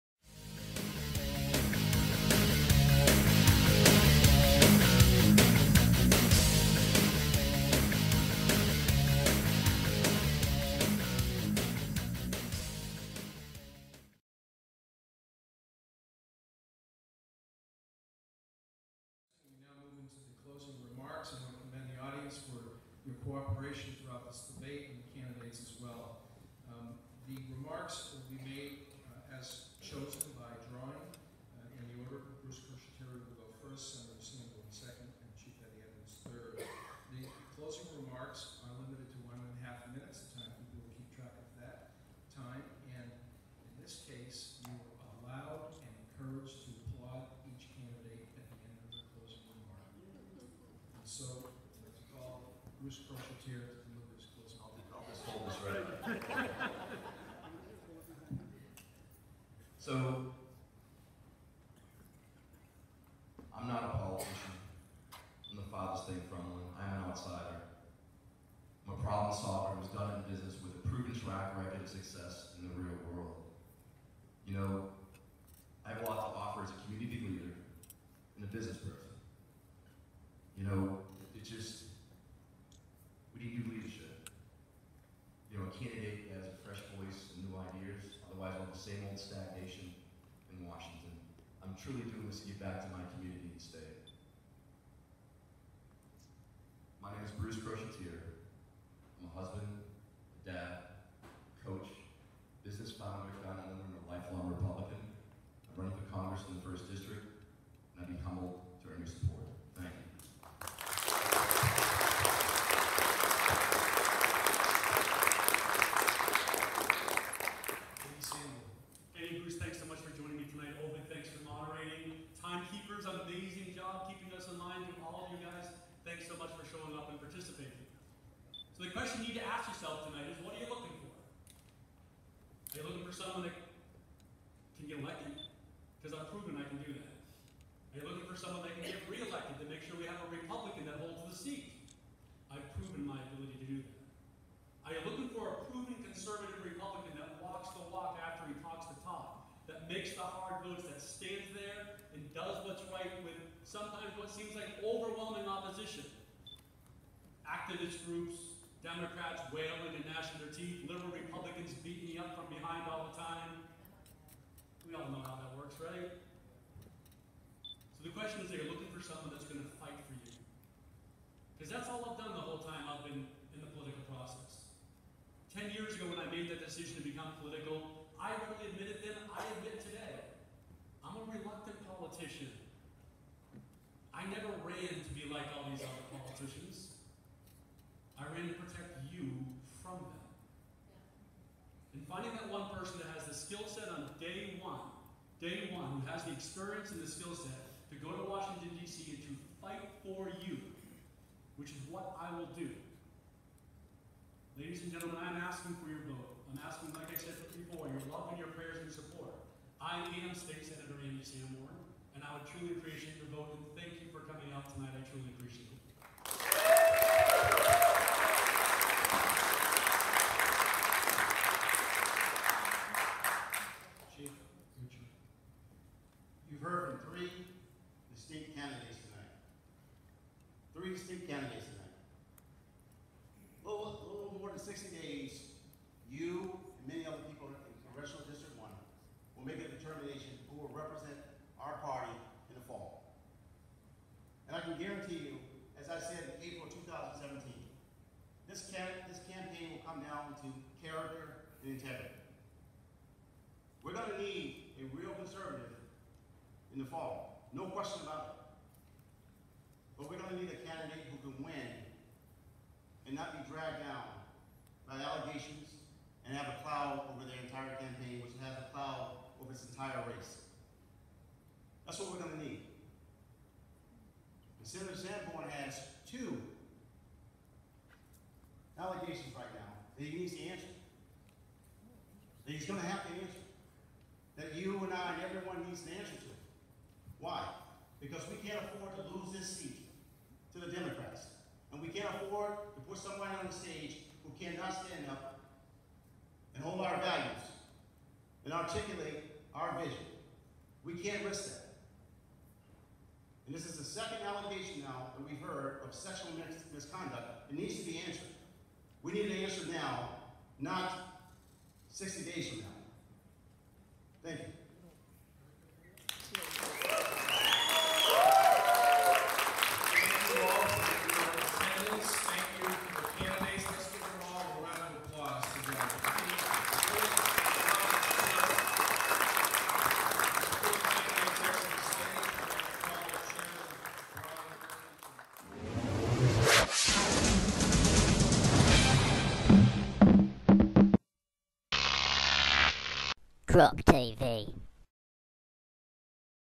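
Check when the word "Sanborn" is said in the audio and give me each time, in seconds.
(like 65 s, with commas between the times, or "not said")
211 s, 274 s.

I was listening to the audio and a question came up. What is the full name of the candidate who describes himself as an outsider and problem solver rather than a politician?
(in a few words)
Bruce Crochetiere.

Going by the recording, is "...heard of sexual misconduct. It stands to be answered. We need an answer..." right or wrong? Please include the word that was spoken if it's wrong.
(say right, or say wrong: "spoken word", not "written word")
wrong: "needs", not "stands".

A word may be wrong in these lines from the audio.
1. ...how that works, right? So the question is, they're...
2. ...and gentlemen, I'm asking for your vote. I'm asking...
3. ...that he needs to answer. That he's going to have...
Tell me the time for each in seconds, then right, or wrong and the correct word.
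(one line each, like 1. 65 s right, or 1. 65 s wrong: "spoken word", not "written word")
1. 165 s right
2. 204 s right
3. 279 s right.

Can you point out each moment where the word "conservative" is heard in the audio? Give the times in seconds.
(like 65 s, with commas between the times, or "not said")
146 s, 255 s.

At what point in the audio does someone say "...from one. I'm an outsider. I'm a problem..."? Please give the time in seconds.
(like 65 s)
66 s.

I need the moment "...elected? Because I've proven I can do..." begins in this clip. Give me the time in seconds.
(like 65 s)
135 s.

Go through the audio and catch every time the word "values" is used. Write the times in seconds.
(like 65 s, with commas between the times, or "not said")
296 s.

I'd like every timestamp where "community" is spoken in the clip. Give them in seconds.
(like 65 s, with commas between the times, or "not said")
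76 s, 93 s.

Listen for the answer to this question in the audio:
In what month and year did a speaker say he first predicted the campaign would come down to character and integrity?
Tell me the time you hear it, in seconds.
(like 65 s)
246 s.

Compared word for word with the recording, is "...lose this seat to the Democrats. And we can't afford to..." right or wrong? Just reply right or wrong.
right.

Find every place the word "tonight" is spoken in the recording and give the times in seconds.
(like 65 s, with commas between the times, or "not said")
130 s, 214 s, 231 s.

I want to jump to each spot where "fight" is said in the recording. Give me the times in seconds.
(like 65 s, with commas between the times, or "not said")
169 s, 199 s.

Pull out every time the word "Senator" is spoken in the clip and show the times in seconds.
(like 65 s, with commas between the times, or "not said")
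210 s, 274 s.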